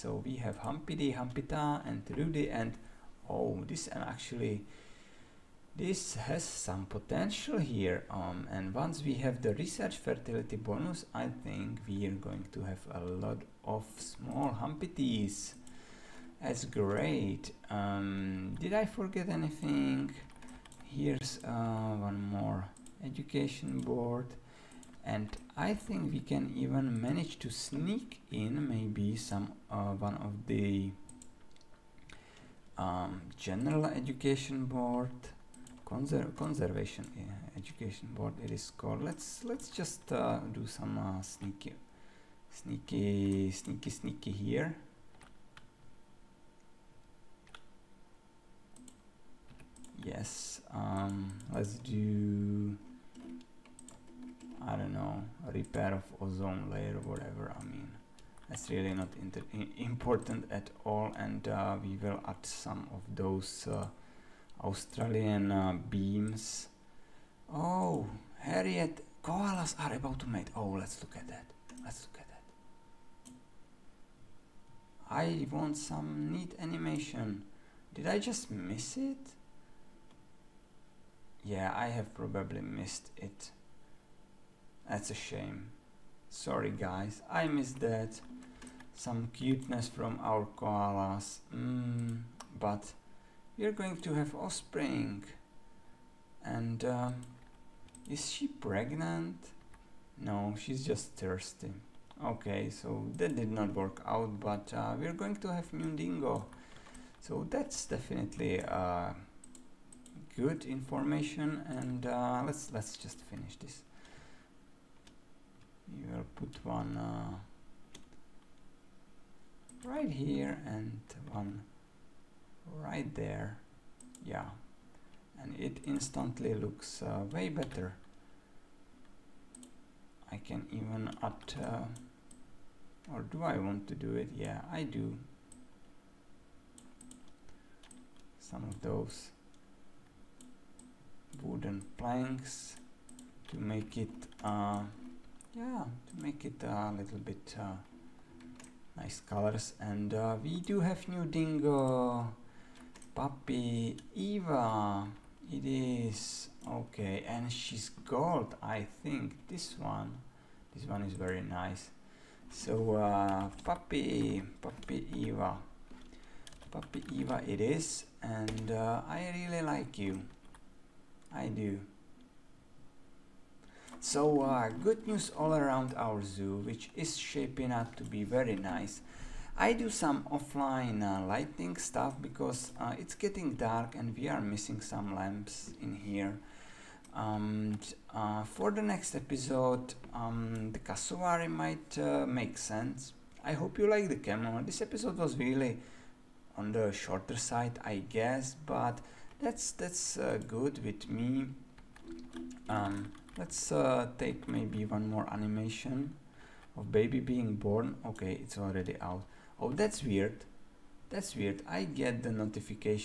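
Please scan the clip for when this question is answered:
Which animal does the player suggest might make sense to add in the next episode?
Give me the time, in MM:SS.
03:10.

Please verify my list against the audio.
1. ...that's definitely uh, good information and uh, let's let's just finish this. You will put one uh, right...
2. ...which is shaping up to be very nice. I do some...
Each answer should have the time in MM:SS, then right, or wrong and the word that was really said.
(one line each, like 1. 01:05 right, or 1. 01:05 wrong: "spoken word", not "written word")
1. 01:47 right
2. 02:56 right.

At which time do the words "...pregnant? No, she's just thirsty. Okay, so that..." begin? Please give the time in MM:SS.
01:38.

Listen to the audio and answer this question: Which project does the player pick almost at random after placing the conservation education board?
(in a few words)
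Repair of ozone layer.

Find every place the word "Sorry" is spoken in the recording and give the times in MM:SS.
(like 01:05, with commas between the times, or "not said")
01:26.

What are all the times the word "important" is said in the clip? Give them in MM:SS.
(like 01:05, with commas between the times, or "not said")
00:59.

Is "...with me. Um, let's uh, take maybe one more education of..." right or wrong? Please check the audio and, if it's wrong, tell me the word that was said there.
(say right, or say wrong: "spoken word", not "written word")
wrong: "animation", not "education".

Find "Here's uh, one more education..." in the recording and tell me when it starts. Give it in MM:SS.
00:20.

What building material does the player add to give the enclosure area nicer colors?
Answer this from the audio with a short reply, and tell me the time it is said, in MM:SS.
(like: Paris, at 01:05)
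Wooden planks, at 02:21.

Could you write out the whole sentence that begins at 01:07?
Oh, Harriet, koalas are about to mate.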